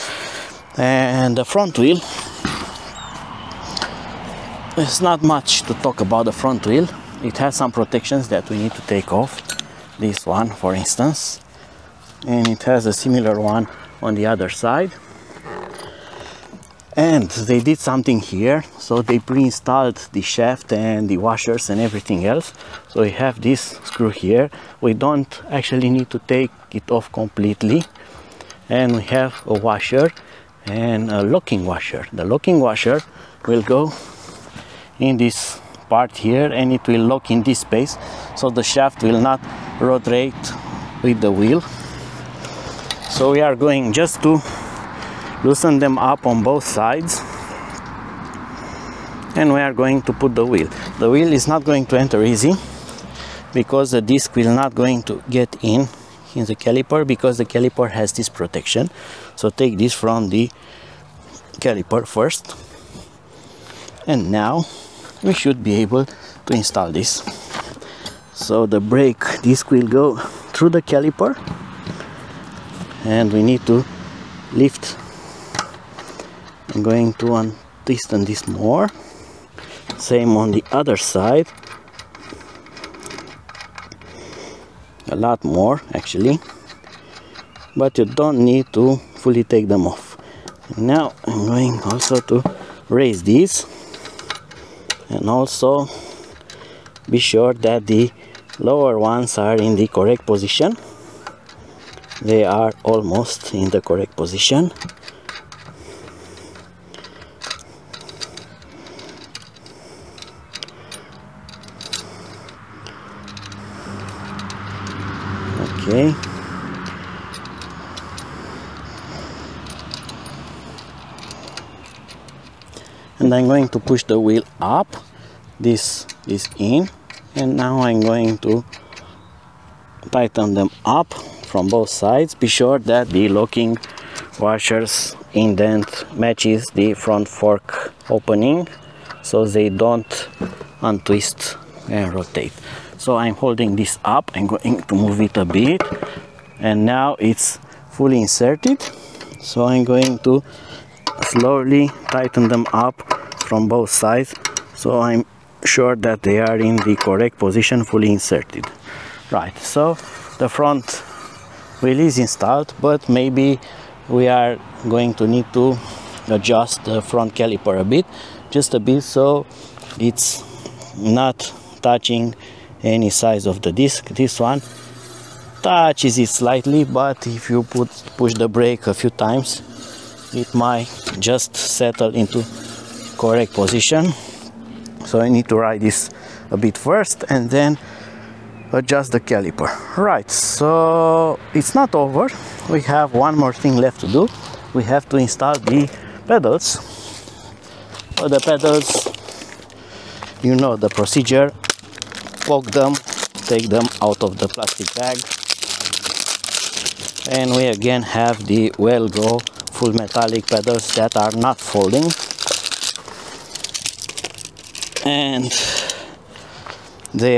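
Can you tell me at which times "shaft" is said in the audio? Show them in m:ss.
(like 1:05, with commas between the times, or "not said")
0:20, 0:38.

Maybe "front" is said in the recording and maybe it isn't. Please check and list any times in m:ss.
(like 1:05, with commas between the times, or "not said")
0:01, 0:06, 2:16, 2:40, 2:47.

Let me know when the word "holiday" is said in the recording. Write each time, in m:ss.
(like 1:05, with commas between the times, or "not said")
not said.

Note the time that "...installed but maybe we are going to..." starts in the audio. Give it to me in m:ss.
2:42.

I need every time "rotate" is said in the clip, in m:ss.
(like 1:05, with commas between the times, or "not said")
0:39, 2:22.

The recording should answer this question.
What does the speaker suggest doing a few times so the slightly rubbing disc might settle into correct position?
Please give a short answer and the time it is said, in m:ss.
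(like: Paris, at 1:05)
Push the brake, at 2:58.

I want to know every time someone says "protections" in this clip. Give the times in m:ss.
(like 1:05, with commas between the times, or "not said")
0:07, 0:58.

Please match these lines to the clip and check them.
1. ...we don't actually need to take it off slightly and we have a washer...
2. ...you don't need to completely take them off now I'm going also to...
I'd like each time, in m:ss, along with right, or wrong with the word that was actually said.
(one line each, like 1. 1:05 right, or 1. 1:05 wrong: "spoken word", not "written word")
1. 0:24 wrong: "completely", not "slightly"
2. 1:27 wrong: "fully", not "completely".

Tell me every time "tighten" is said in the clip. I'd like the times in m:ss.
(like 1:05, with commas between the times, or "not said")
2:10, 2:32.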